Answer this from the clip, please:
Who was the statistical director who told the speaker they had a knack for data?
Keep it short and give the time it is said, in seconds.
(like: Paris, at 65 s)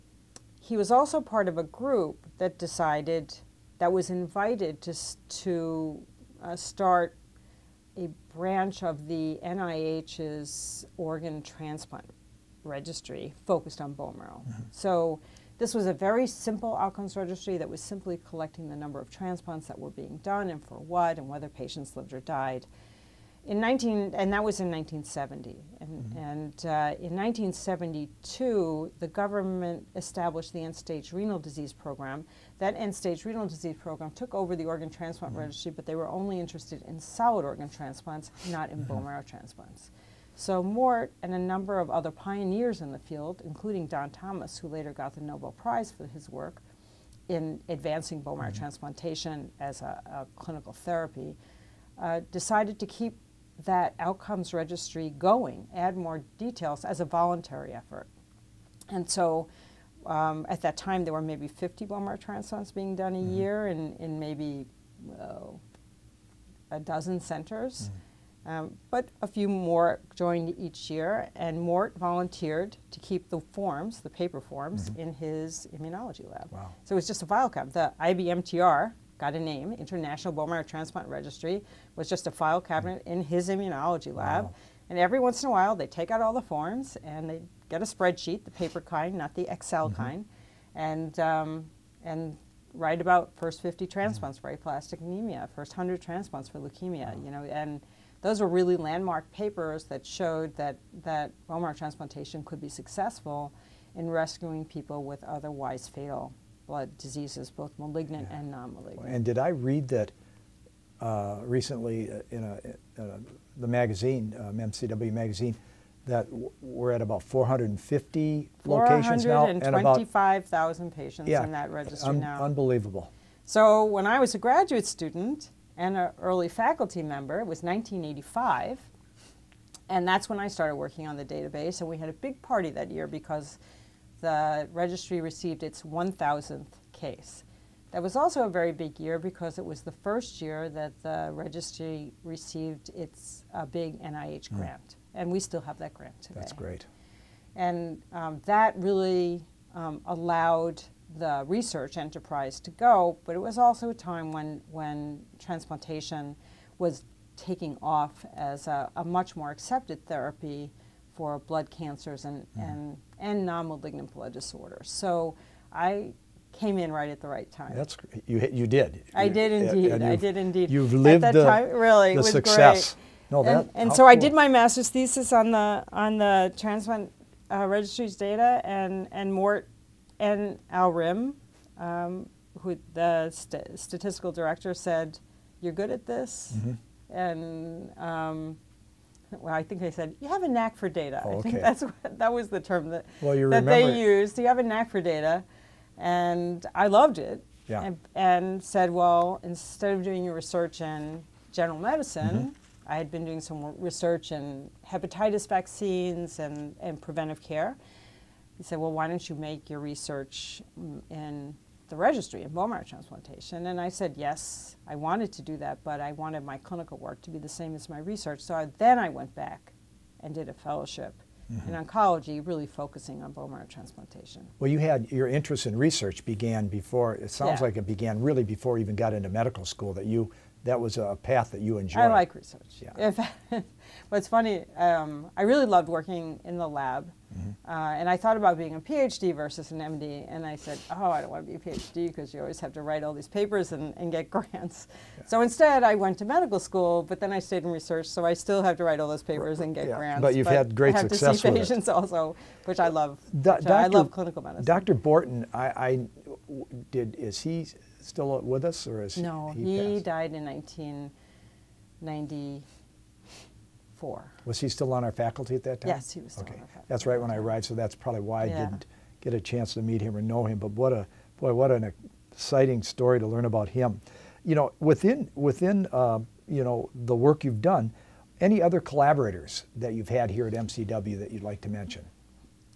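Al Rimm, at 180 s.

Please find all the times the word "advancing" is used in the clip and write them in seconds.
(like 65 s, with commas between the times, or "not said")
47 s.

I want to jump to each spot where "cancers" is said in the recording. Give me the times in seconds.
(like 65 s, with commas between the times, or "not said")
161 s.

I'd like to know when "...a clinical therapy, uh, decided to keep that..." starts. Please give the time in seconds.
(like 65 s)
50 s.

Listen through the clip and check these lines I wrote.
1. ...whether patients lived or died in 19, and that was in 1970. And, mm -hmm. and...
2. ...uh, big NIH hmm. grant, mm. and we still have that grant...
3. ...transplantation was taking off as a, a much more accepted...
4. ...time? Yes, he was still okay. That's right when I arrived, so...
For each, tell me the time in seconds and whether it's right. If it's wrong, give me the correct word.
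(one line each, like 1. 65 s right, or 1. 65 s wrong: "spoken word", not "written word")
1. 21 s right
2. 143 s right
3. 155 s right
4. 265 s right.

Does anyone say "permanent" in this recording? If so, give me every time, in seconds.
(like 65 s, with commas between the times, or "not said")
not said.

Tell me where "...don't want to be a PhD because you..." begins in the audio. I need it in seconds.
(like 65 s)
241 s.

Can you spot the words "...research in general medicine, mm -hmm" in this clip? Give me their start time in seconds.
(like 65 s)
200 s.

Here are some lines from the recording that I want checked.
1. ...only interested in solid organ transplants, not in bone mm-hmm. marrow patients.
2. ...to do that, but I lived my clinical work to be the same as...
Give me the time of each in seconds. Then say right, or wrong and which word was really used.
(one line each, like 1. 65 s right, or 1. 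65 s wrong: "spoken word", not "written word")
1. 36 s wrong: "transplants", not "patients"
2. 215 s wrong: "wanted", not "lived".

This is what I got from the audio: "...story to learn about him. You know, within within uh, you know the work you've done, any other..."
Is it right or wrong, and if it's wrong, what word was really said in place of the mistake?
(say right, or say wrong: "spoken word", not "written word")
right.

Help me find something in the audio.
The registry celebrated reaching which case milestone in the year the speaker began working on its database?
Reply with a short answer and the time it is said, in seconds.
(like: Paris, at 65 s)
1,000th case, at 135 s.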